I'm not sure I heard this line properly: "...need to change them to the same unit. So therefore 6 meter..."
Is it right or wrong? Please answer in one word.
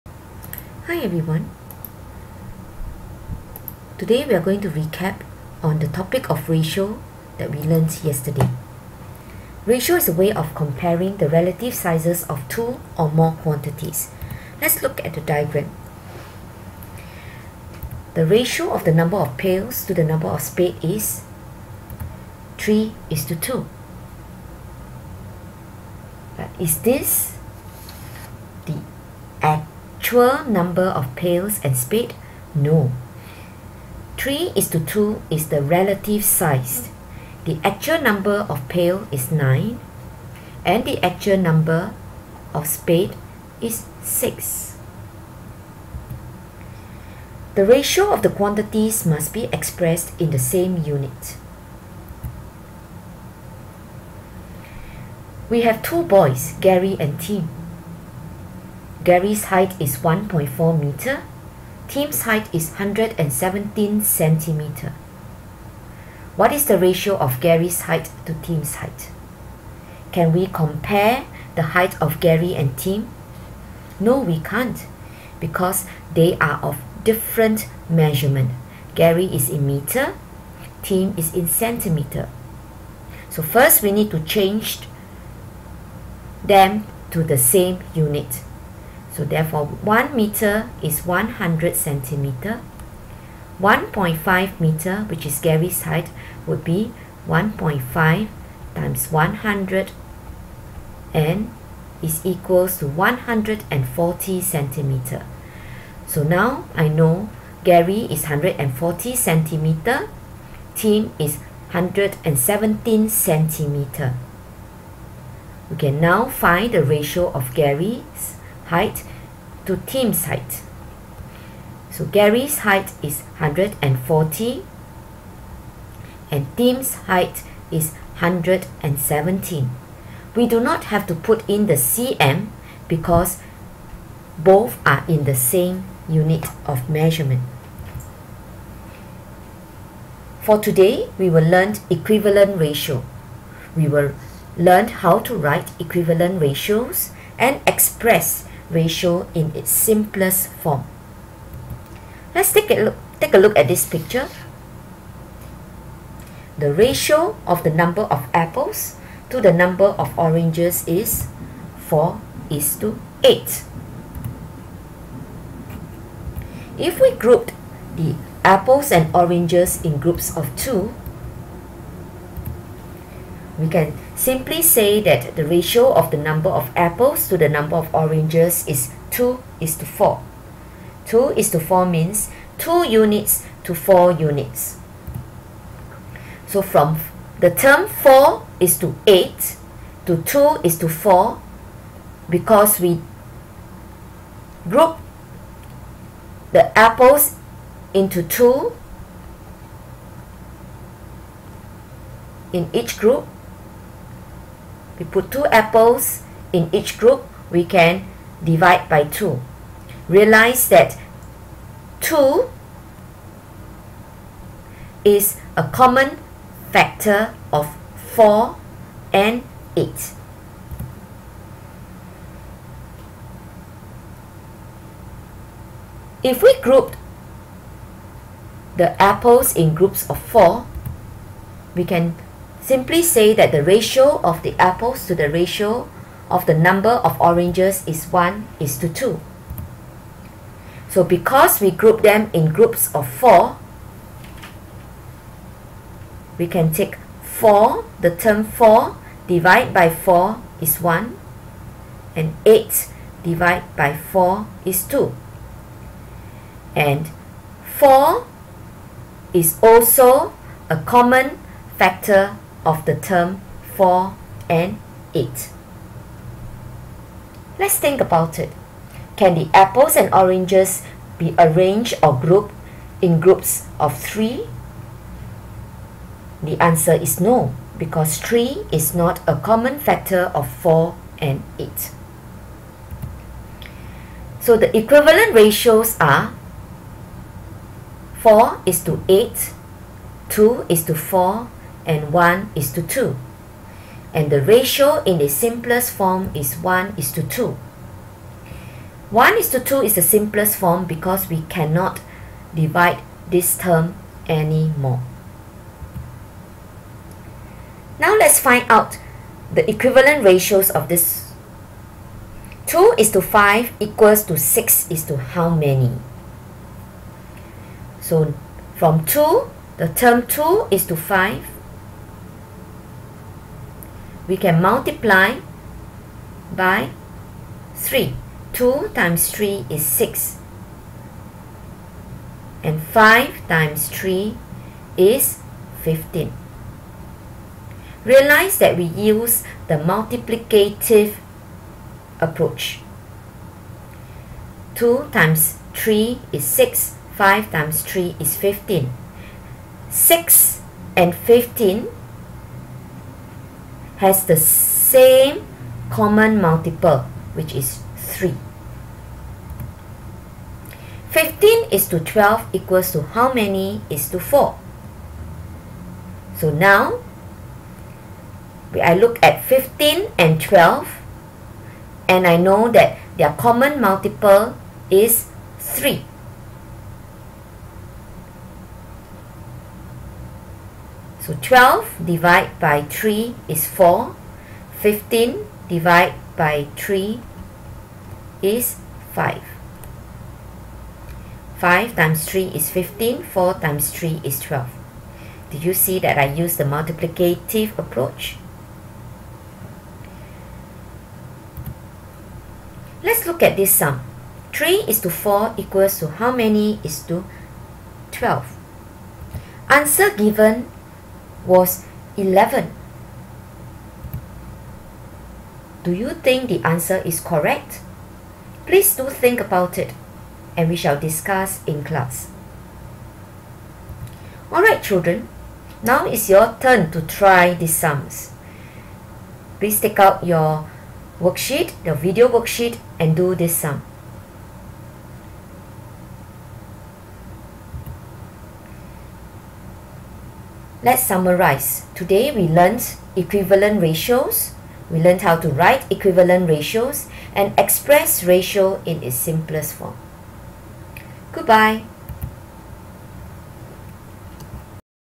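wrong.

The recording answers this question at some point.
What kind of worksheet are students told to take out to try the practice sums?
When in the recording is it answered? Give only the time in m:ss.
7:11.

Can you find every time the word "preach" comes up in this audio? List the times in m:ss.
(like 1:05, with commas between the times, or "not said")
not said.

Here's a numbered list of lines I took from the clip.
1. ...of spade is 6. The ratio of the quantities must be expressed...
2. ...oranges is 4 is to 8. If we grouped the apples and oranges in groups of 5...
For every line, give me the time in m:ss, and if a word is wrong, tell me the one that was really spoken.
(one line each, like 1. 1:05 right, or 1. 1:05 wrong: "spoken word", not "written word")
1. 0:42 right
2. 2:40 wrong: "2", not "5".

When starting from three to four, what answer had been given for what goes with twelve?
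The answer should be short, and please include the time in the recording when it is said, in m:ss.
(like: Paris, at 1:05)
11, at 6:52.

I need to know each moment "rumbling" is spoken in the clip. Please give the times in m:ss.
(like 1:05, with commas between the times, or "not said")
not said.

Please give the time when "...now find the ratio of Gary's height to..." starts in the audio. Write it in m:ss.
1:56.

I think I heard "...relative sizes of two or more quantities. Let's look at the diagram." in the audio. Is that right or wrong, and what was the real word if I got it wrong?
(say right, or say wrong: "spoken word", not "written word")
right.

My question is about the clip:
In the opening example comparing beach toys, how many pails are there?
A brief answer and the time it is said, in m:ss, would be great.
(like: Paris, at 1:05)
9, at 0:39.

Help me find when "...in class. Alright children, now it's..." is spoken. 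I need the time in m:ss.
7:01.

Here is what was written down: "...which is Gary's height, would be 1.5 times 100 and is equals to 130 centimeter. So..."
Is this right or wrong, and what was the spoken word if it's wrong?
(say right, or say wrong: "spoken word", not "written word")
wrong: "140", not "130".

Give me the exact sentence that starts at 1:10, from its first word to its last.
Can we compare the height of Gary and Tim?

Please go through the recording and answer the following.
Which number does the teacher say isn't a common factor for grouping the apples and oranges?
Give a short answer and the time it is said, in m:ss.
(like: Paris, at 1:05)
3, at 4:34.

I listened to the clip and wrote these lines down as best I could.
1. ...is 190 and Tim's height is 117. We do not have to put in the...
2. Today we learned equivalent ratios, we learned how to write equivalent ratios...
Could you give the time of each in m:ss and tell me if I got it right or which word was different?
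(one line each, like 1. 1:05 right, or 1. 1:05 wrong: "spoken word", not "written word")
1. 2:03 wrong: "140", not "190"
2. 7:21 right.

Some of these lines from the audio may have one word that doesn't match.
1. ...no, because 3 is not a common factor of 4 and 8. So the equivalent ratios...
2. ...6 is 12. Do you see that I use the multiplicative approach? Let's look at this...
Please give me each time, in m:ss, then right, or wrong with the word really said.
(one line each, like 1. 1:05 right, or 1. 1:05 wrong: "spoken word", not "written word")
1. 4:37 right
2. 6:33 wrong: "3", not "6".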